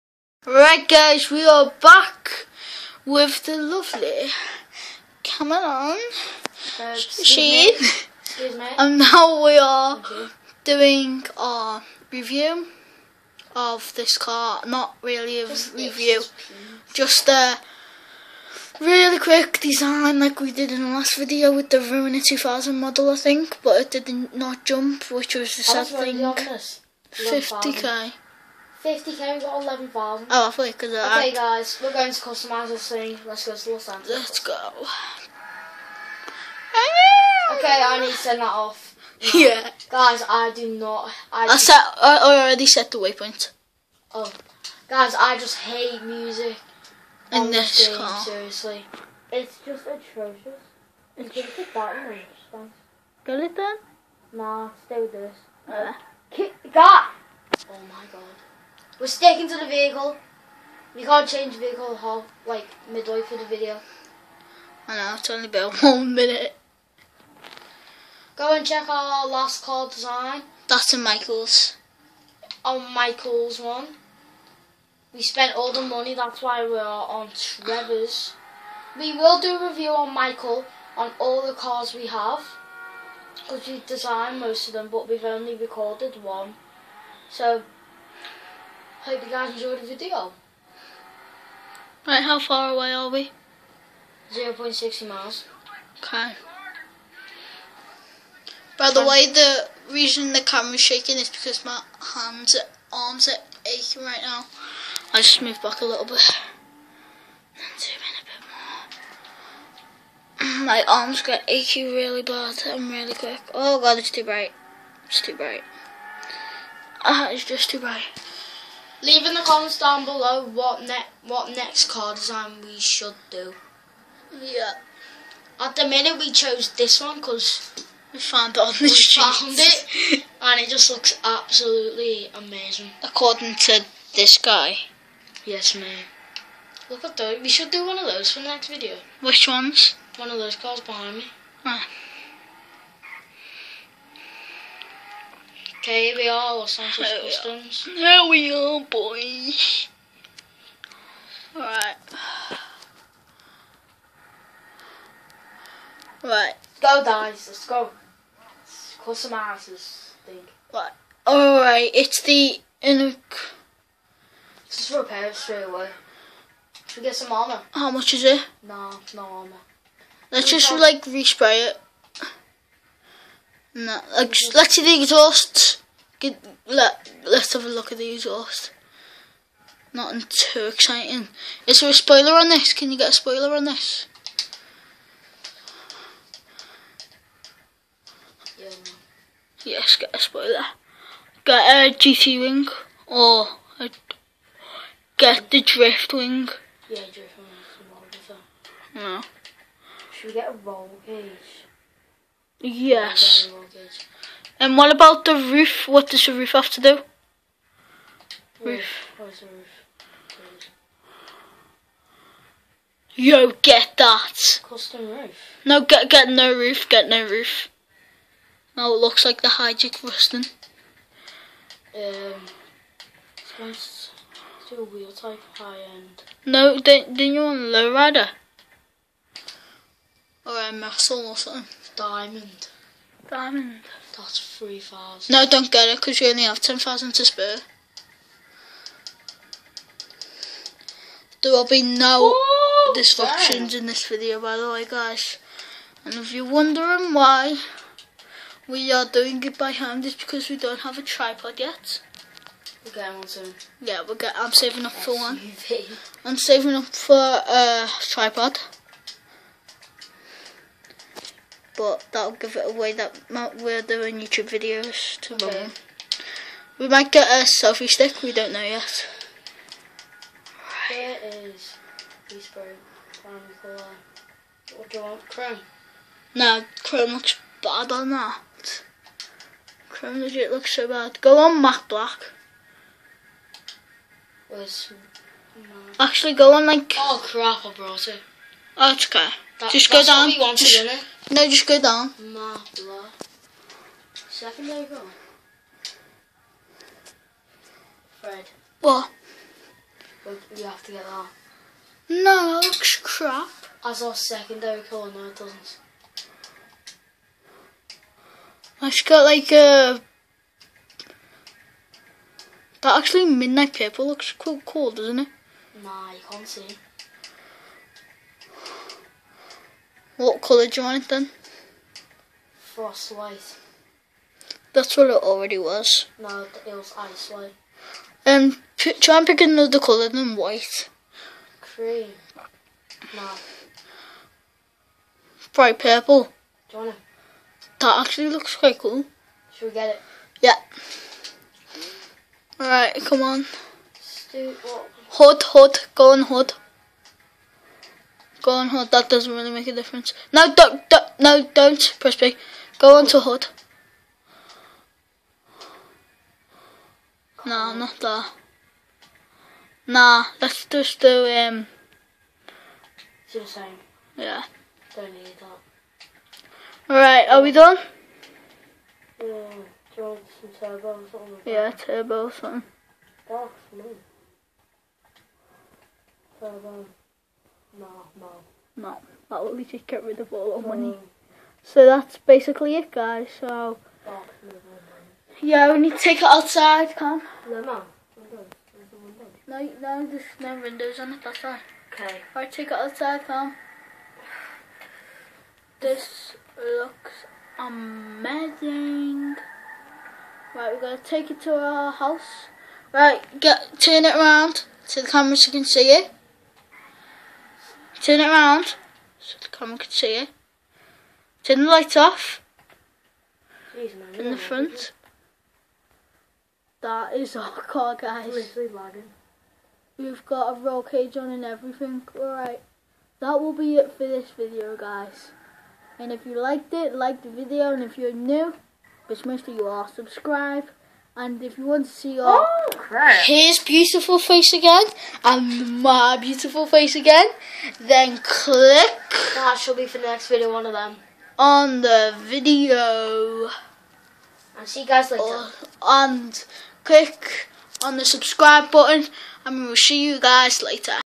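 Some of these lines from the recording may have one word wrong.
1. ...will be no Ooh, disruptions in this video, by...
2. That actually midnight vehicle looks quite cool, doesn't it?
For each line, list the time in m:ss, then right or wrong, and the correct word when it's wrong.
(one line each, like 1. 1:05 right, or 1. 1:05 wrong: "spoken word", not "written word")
1. 4:01 right
2. 5:12 wrong: "purple", not "vehicle".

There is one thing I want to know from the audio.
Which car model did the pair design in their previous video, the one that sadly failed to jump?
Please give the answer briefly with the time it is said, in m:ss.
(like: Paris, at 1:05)
Ruiner 2000, at 0:21.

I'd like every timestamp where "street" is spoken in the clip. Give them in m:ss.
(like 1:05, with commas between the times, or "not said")
2:08.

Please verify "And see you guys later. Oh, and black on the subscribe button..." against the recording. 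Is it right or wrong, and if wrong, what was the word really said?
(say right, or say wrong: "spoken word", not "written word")
wrong: "click", not "black".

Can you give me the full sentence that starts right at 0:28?
50k, we got 11 Oh, I thought because could.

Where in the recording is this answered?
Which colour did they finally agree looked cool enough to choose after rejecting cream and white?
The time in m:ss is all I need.
5:35.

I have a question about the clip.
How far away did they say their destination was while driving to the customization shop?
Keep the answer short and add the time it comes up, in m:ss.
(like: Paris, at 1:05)
0.60 miles, at 1:34.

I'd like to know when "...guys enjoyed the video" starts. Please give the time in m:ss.
1:29.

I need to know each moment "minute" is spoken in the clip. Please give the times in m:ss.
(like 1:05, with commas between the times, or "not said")
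1:06, 2:05.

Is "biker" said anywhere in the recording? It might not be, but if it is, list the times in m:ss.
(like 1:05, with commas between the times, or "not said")
not said.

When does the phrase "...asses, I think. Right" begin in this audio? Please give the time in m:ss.
2:39.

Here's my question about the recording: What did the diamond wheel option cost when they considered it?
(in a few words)
3,000.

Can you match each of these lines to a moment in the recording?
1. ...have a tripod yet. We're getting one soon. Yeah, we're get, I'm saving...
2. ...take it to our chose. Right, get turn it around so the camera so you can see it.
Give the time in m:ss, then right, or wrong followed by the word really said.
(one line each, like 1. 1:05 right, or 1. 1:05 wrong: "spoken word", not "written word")
1. 4:10 right
2. 6:41 wrong: "house", not "chose".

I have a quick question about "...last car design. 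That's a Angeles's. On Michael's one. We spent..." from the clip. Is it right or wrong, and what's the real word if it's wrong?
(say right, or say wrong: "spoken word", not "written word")
wrong: "Michael", not "Angeles".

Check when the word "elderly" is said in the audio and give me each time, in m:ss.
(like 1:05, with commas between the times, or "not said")
not said.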